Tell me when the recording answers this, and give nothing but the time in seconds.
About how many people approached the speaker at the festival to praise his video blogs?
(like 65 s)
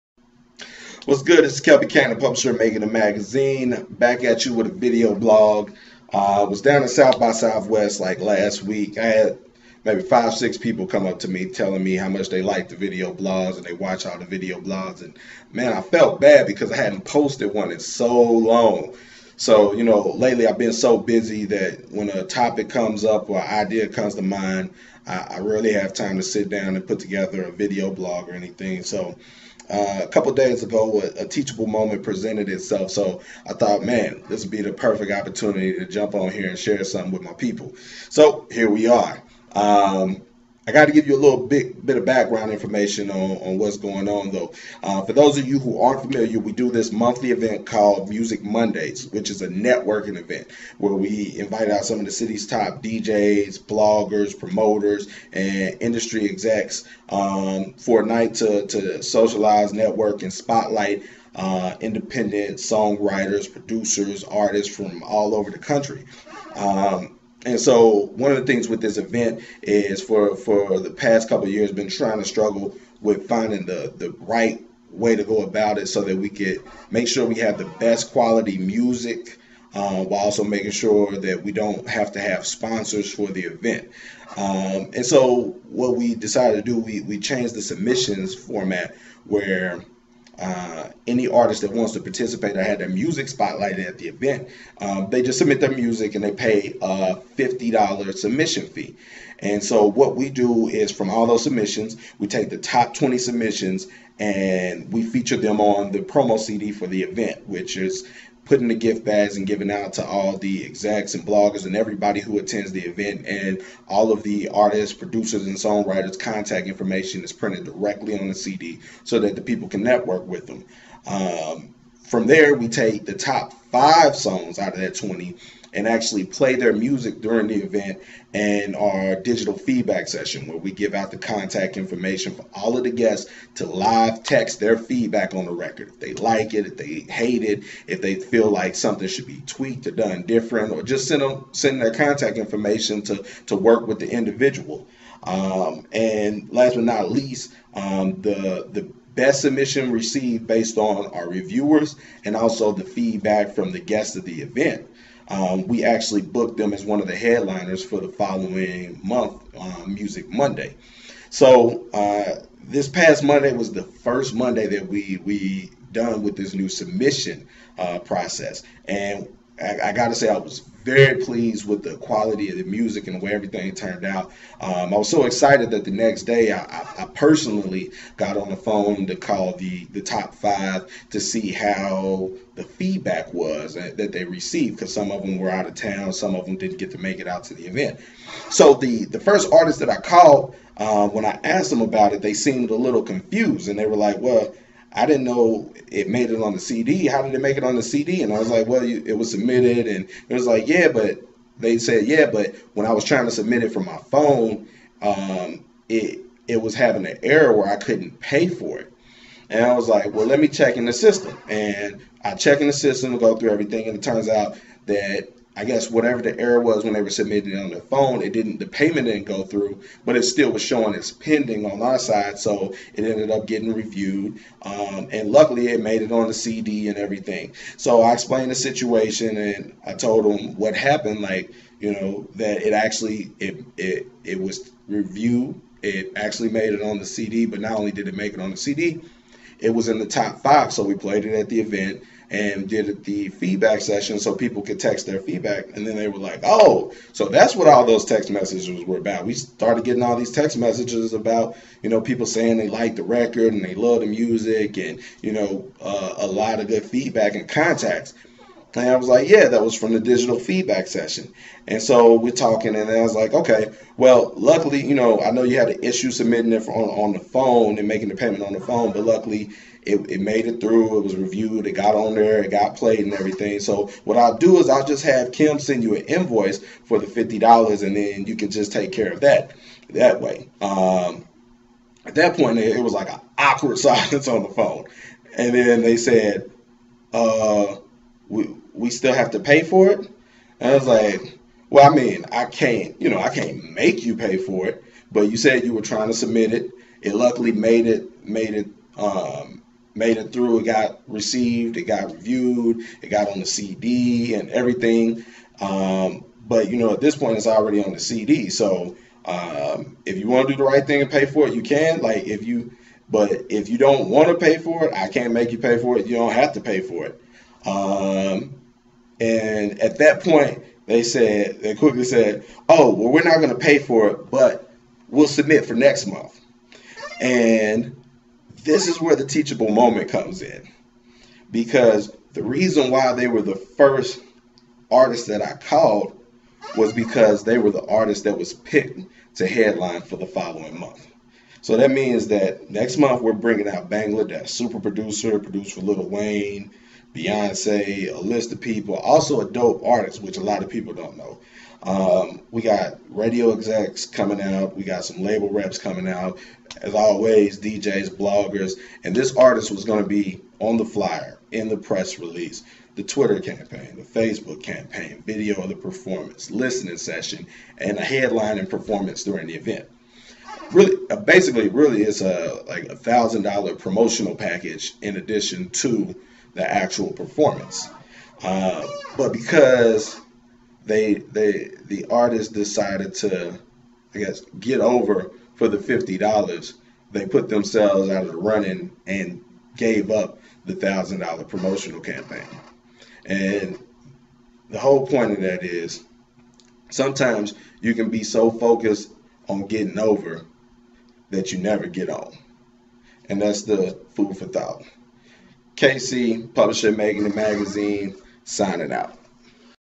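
10 s.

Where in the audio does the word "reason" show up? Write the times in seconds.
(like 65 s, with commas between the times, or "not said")
332 s.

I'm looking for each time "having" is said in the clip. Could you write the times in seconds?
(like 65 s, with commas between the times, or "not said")
206 s.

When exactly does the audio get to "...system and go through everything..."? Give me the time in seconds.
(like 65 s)
212 s.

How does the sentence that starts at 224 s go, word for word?
Um, and luckily, it made it on the CD and everything.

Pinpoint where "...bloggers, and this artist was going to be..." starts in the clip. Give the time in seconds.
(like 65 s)
358 s.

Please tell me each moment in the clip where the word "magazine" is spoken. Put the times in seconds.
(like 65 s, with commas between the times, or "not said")
2 s, 407 s.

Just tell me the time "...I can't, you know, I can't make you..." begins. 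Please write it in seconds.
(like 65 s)
292 s.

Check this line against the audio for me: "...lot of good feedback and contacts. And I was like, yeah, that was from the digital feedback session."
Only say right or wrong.
right.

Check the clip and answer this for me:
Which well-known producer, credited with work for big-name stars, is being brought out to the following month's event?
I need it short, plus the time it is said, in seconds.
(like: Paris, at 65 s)
Bangladesh, at 343 s.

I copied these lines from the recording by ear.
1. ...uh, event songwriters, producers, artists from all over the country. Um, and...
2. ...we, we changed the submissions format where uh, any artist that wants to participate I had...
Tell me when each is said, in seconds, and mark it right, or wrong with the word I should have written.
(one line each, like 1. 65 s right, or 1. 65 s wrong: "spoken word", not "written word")
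1. 61 s wrong: "independent", not "event"
2. 86 s right.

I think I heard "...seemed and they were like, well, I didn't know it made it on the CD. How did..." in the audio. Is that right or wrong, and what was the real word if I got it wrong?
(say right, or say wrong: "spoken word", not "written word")
wrong: "confused", not "seemed".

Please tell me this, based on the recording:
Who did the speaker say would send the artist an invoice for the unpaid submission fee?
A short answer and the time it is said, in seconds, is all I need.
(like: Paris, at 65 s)
Kim, at 275 s.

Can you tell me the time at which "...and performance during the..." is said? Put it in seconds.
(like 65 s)
368 s.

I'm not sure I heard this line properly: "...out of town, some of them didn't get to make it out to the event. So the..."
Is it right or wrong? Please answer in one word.
right.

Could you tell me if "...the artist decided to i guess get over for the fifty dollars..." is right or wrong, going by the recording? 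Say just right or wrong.
right.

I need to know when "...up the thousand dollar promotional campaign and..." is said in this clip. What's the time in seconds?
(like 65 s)
390 s.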